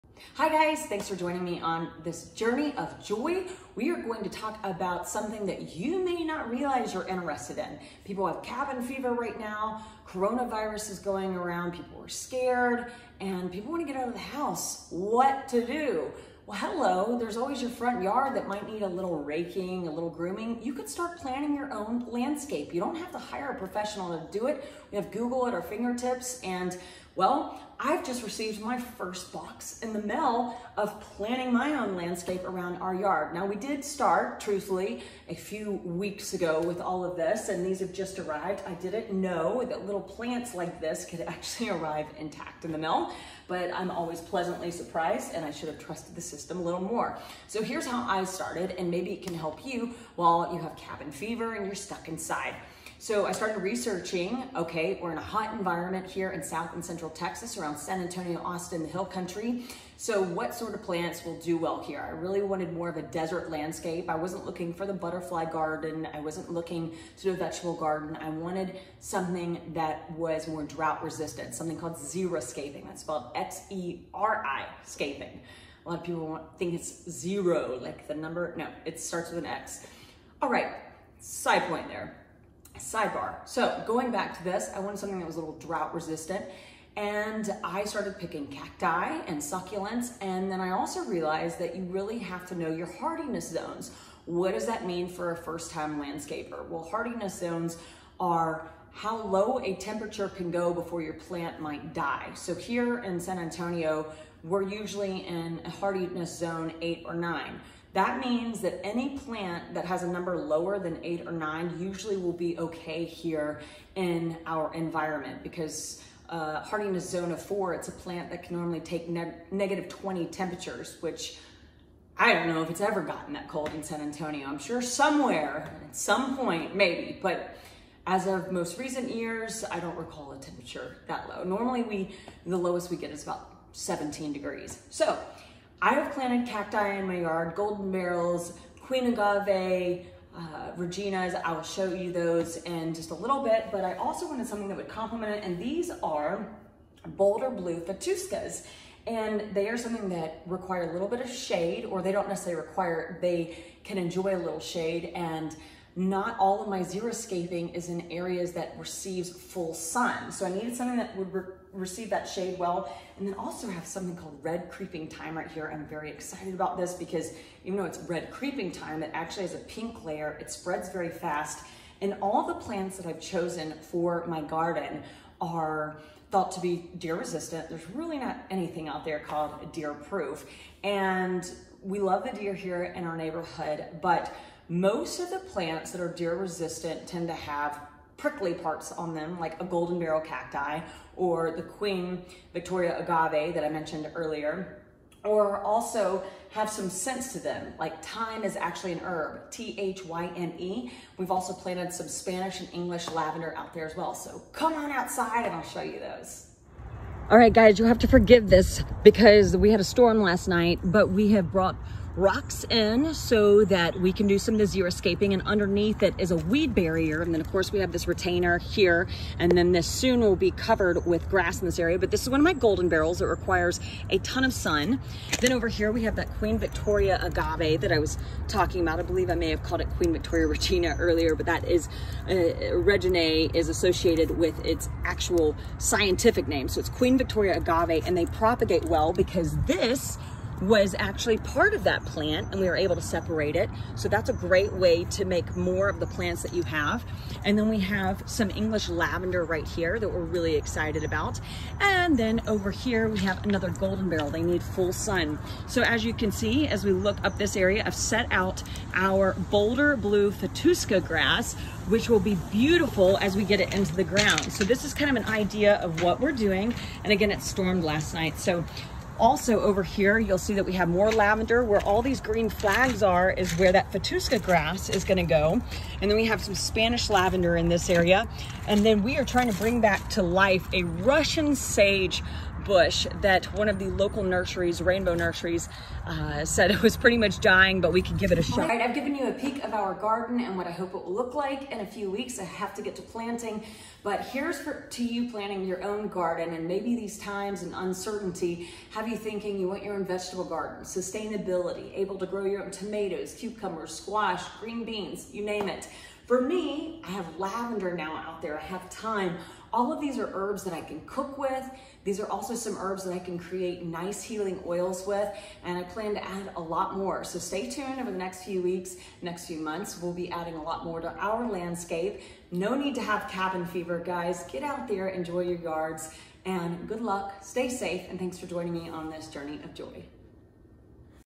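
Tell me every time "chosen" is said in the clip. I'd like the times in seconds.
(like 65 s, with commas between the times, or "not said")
173 s.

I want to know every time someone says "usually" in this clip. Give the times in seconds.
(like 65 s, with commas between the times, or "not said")
104 s, 111 s.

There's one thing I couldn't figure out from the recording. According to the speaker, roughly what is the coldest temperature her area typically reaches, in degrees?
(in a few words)
17 degrees.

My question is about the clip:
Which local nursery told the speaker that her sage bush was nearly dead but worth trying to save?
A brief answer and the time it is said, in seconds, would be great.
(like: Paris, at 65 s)
Rainbow Nurseries, at 284 s.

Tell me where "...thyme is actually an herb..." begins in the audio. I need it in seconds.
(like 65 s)
198 s.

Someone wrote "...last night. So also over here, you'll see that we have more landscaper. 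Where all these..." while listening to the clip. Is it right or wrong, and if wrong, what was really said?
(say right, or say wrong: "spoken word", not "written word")
wrong: "lavender", not "landscaper".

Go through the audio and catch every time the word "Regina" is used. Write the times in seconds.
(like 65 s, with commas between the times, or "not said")
140 s, 230 s.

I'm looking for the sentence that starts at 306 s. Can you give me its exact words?
For me, I have lavender now out there.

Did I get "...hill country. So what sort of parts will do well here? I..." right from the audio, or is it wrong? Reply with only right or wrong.
wrong.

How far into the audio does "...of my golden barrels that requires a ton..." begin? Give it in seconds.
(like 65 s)
222 s.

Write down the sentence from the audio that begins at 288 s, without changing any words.
All right, I've given you a peek of our garden and what I hope it will look like in a few weeks.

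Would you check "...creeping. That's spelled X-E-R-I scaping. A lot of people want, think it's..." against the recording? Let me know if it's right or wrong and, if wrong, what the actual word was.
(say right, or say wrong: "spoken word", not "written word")
wrong: "xeriscaping", not "creeping".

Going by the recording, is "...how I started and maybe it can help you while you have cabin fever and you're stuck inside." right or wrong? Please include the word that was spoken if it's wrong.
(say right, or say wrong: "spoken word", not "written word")
right.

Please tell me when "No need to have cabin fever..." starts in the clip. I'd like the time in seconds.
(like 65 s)
322 s.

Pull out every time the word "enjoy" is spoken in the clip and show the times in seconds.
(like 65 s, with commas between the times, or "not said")
153 s, 325 s.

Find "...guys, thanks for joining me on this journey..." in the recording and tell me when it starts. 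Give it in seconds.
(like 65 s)
0 s.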